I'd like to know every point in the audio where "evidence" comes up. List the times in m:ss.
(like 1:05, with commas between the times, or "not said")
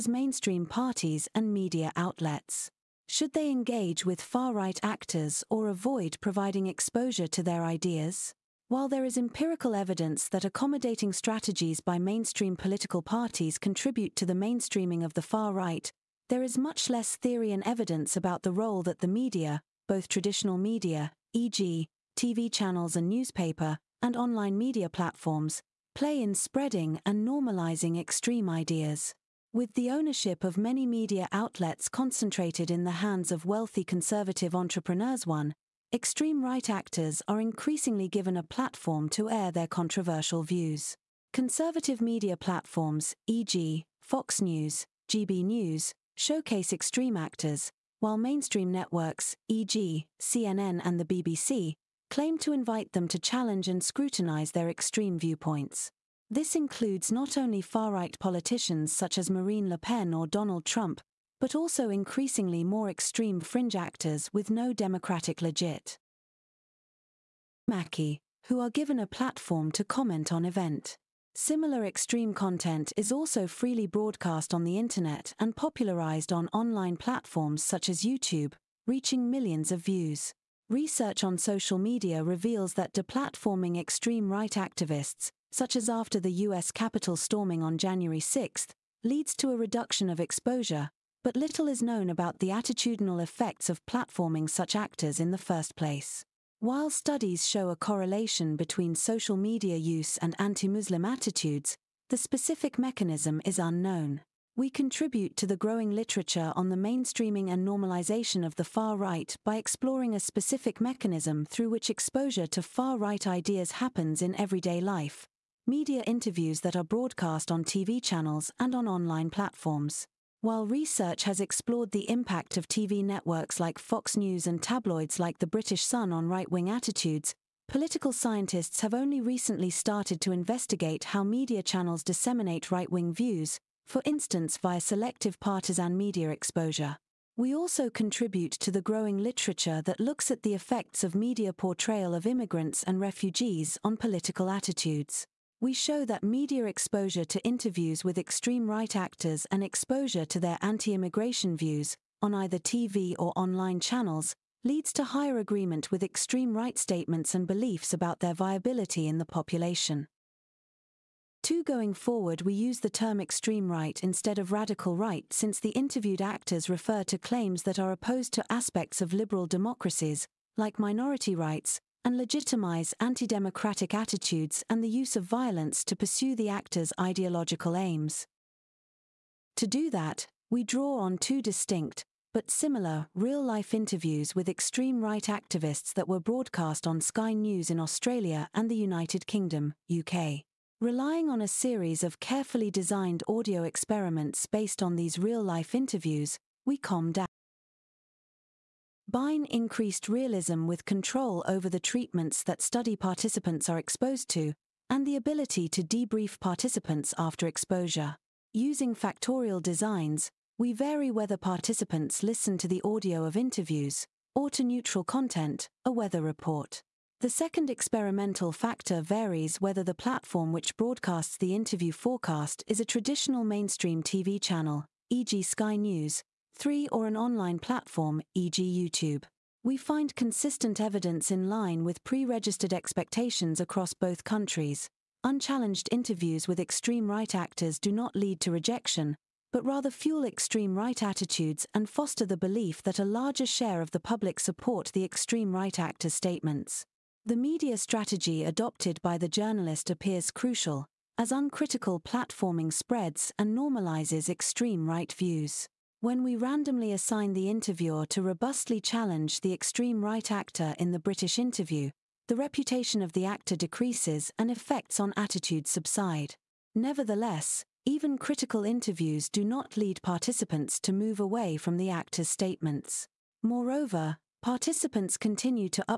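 0:09, 0:17, 3:50.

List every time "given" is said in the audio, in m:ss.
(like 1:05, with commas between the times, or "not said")
0:38, 1:08.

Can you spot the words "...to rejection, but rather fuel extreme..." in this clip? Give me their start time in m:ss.
3:58.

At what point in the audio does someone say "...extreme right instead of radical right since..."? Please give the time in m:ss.
2:43.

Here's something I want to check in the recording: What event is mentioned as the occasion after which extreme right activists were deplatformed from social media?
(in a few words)
US Capitol storming.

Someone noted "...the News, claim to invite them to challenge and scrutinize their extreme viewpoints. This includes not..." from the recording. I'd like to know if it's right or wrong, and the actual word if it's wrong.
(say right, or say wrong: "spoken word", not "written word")
wrong: "BBC", not "News".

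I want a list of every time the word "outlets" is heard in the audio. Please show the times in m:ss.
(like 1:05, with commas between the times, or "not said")
0:01, 0:31.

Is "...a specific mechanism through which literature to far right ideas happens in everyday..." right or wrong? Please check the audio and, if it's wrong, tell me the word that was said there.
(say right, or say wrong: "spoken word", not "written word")
wrong: "exposure", not "literature".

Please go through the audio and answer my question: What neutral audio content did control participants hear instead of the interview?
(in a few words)
A weather report.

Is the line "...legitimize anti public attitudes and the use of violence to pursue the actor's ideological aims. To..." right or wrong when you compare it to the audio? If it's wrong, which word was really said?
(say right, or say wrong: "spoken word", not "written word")
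wrong: "democratic", not "public".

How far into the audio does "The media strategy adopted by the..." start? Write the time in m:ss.
4:07.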